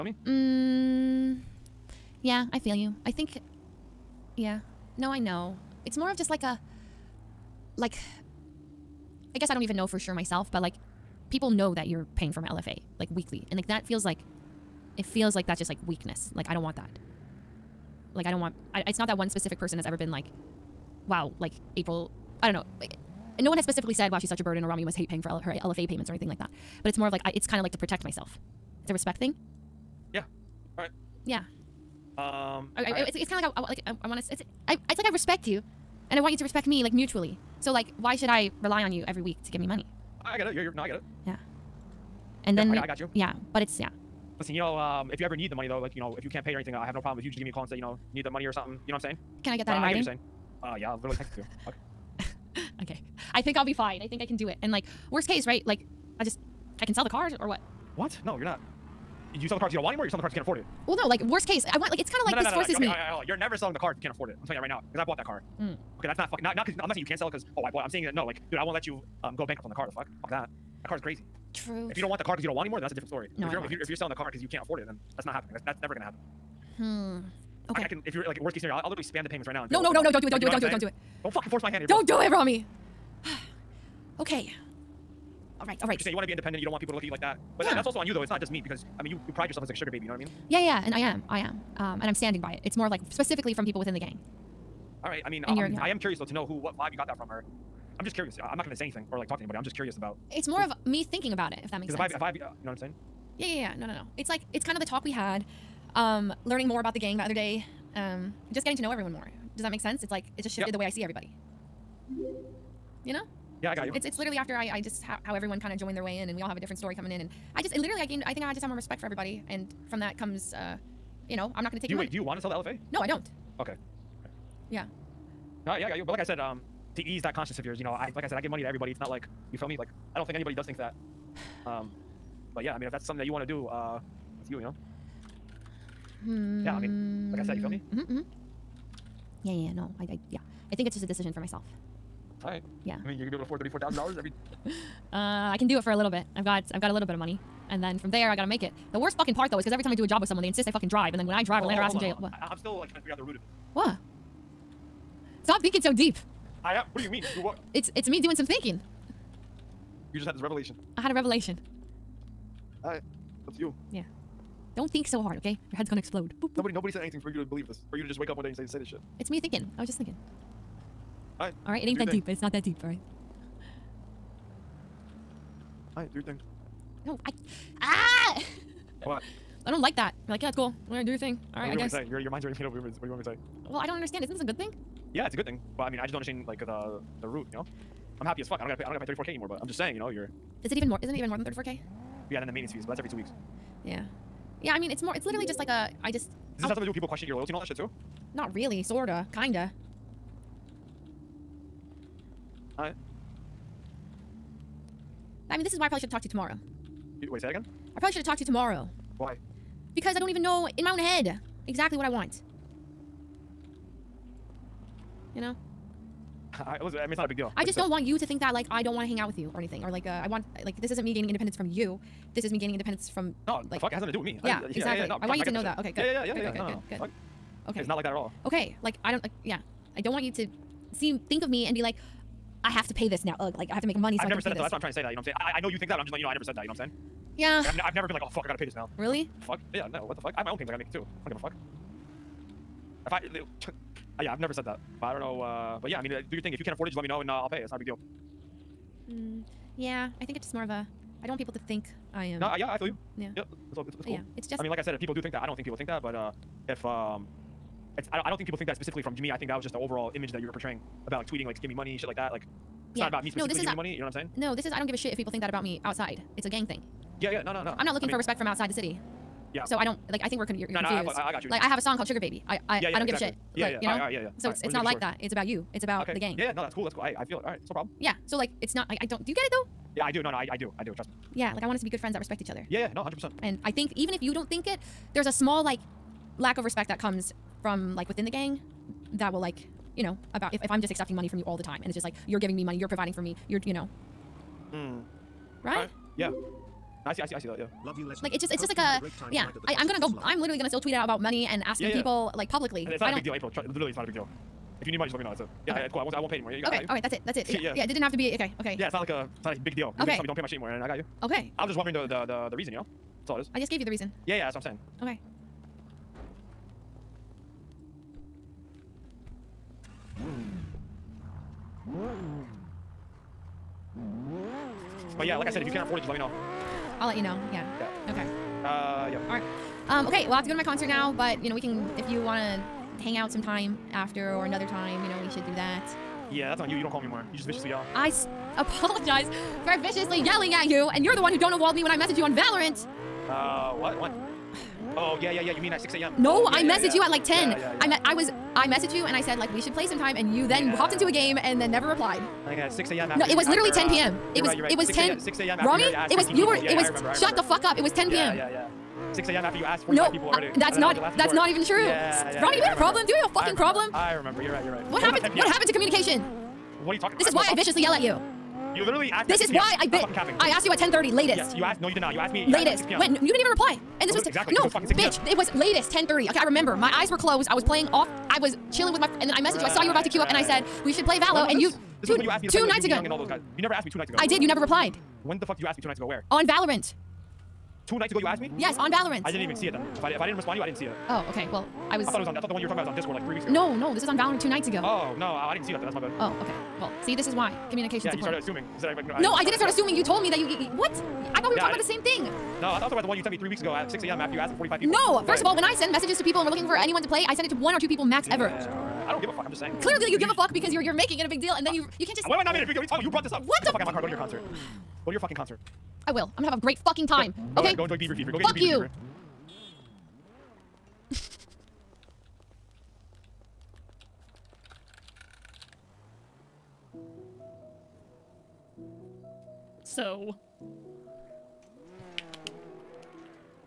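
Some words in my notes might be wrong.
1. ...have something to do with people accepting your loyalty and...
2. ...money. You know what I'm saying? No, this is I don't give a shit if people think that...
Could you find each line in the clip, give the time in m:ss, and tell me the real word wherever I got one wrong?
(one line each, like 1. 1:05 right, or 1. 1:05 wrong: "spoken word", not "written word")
1. 3:16 wrong: "questioning", not "accepting"
2. 4:23 right.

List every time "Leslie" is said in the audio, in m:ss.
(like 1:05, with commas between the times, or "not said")
4:58.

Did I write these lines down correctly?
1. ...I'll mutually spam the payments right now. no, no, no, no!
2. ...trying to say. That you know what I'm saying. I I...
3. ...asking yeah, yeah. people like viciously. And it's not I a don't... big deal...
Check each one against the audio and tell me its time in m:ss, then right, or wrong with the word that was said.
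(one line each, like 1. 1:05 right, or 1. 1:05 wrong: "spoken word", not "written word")
1. 1:18 wrong: "literally", not "mutually"
2. 3:54 right
3. 5:01 wrong: "publicly", not "viciously".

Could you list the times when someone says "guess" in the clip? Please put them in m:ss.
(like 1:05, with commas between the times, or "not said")
0:09, 3:01.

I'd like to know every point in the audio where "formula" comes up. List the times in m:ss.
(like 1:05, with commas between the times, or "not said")
not said.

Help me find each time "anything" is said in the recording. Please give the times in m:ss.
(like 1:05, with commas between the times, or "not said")
0:26, 0:46, 1:38, 2:47, 3:39.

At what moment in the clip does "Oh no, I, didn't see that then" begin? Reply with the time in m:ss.
6:34.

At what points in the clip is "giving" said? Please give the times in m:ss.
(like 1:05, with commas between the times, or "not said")
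4:23, 4:52.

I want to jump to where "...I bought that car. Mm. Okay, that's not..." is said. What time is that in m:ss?
1:04.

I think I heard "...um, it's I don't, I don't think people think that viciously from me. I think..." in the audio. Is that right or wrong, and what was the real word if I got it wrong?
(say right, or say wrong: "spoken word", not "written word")
wrong: "specifically", not "viciously".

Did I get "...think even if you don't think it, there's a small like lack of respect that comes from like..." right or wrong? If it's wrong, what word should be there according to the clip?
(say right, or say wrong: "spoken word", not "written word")
right.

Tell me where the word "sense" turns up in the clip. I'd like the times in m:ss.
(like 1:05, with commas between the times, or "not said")
1:41, 1:49.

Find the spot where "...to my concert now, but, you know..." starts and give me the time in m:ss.
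5:30.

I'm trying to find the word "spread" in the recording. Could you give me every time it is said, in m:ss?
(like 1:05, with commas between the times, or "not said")
not said.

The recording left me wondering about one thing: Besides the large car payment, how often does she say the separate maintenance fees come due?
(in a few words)
every two weeks.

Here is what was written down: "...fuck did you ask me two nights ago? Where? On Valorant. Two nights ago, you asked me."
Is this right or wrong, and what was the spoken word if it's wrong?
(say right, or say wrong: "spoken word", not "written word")
right.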